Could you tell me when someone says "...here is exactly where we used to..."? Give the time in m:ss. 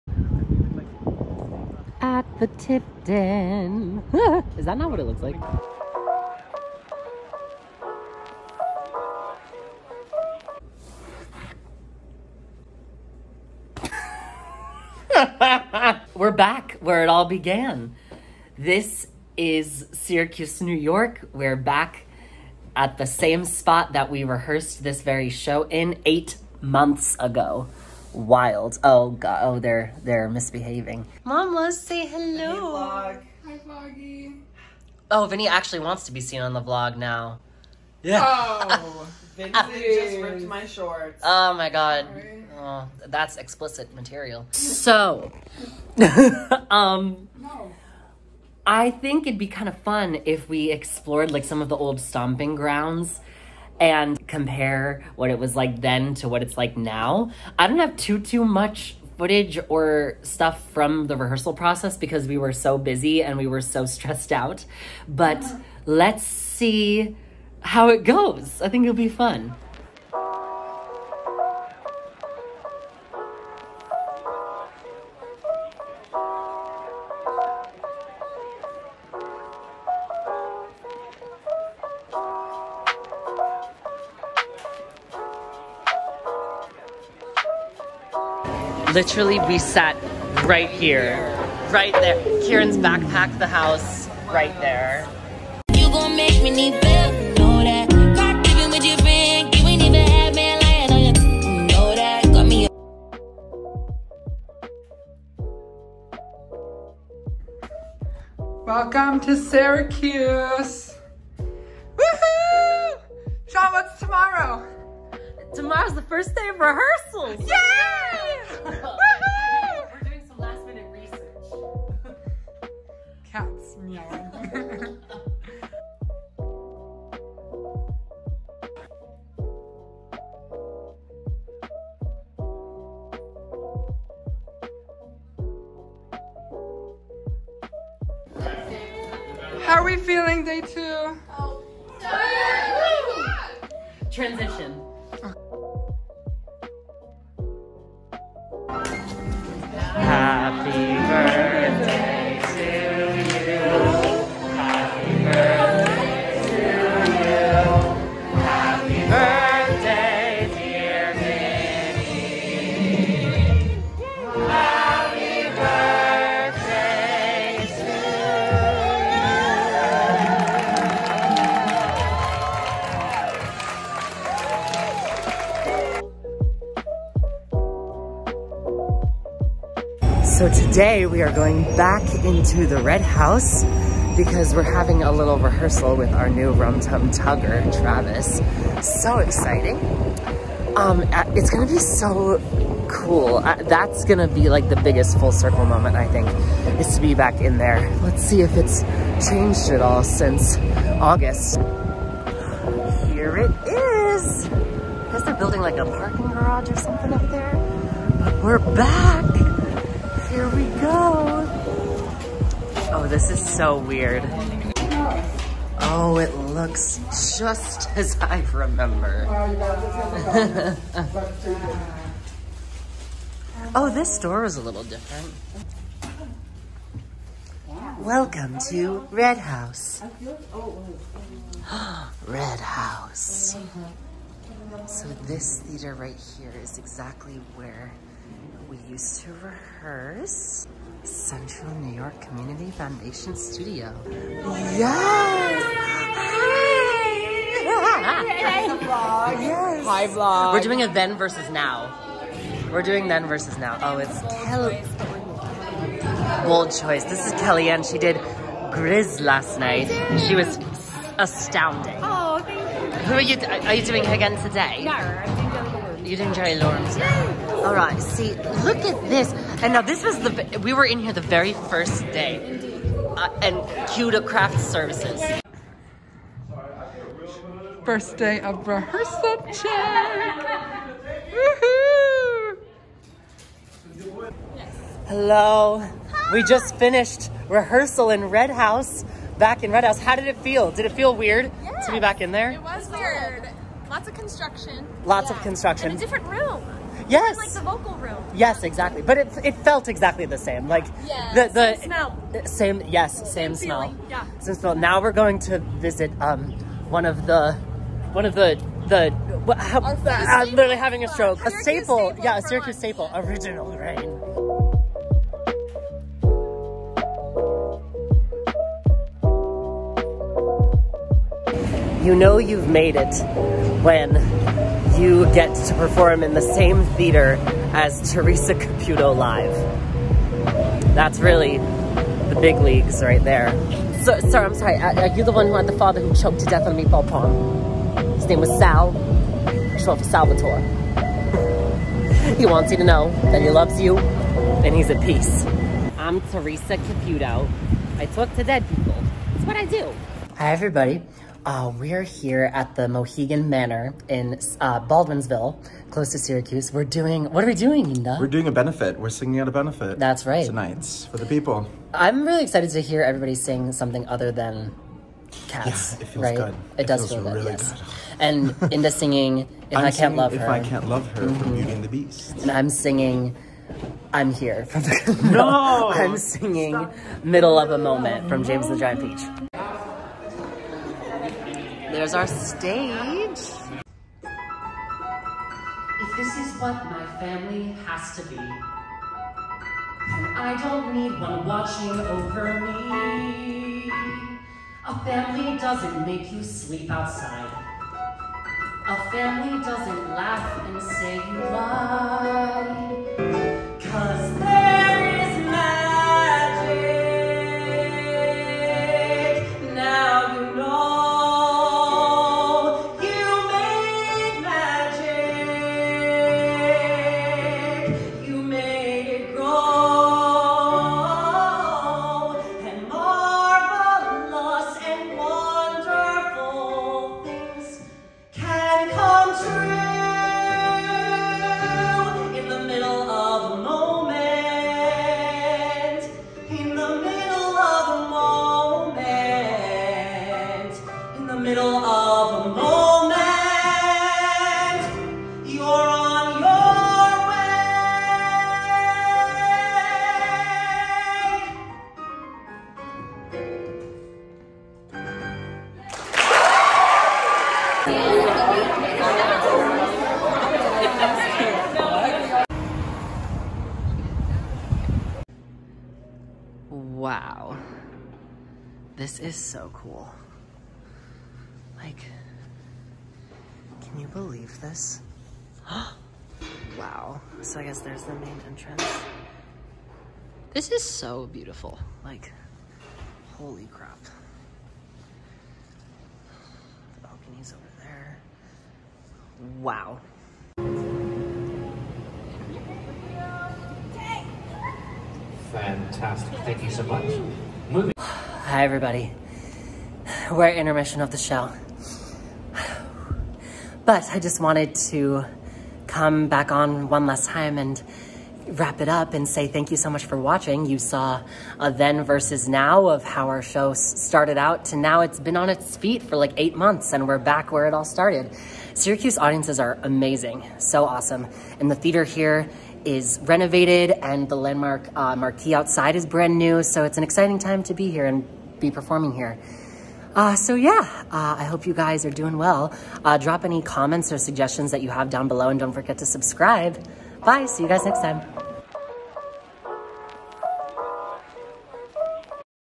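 3:56.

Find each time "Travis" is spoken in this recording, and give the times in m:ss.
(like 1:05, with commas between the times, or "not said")
3:07.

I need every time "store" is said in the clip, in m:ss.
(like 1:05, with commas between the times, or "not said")
3:44.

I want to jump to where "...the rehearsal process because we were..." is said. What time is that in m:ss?
1:01.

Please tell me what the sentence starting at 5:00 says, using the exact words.
Like yeah, the, the same smell.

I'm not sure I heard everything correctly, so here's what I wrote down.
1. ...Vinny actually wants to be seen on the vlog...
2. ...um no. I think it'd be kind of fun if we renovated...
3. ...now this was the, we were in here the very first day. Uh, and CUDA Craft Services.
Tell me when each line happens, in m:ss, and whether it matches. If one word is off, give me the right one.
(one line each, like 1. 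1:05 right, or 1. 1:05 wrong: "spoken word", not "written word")
1. 0:35 right
2. 0:46 wrong: "explored", not "renovated"
3. 4:29 right.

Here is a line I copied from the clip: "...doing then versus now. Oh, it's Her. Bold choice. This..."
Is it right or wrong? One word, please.
wrong.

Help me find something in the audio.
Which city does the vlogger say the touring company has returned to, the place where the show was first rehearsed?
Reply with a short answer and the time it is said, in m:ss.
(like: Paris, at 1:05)
Syracuse, New York, at 0:19.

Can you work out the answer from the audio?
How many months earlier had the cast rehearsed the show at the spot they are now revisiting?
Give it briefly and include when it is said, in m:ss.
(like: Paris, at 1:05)
8, at 0:26.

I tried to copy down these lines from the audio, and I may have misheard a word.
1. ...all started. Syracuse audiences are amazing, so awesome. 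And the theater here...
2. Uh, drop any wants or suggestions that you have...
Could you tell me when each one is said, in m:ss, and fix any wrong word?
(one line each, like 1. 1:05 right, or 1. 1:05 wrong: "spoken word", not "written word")
1. 8:37 right
2. 8:53 wrong: "comments", not "wants".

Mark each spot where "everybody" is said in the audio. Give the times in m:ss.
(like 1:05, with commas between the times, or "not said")
5:50, 6:03, 8:18.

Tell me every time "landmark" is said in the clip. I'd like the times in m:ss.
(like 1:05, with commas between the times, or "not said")
8:44.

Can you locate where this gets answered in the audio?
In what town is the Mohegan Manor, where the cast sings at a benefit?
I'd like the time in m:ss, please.
5:54.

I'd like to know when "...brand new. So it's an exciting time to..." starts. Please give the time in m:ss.
8:46.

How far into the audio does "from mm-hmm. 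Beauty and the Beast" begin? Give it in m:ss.
6:11.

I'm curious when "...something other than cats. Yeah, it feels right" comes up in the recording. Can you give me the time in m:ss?
6:03.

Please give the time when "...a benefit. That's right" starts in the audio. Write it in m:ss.
5:59.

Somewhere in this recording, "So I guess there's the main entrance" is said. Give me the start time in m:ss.
7:57.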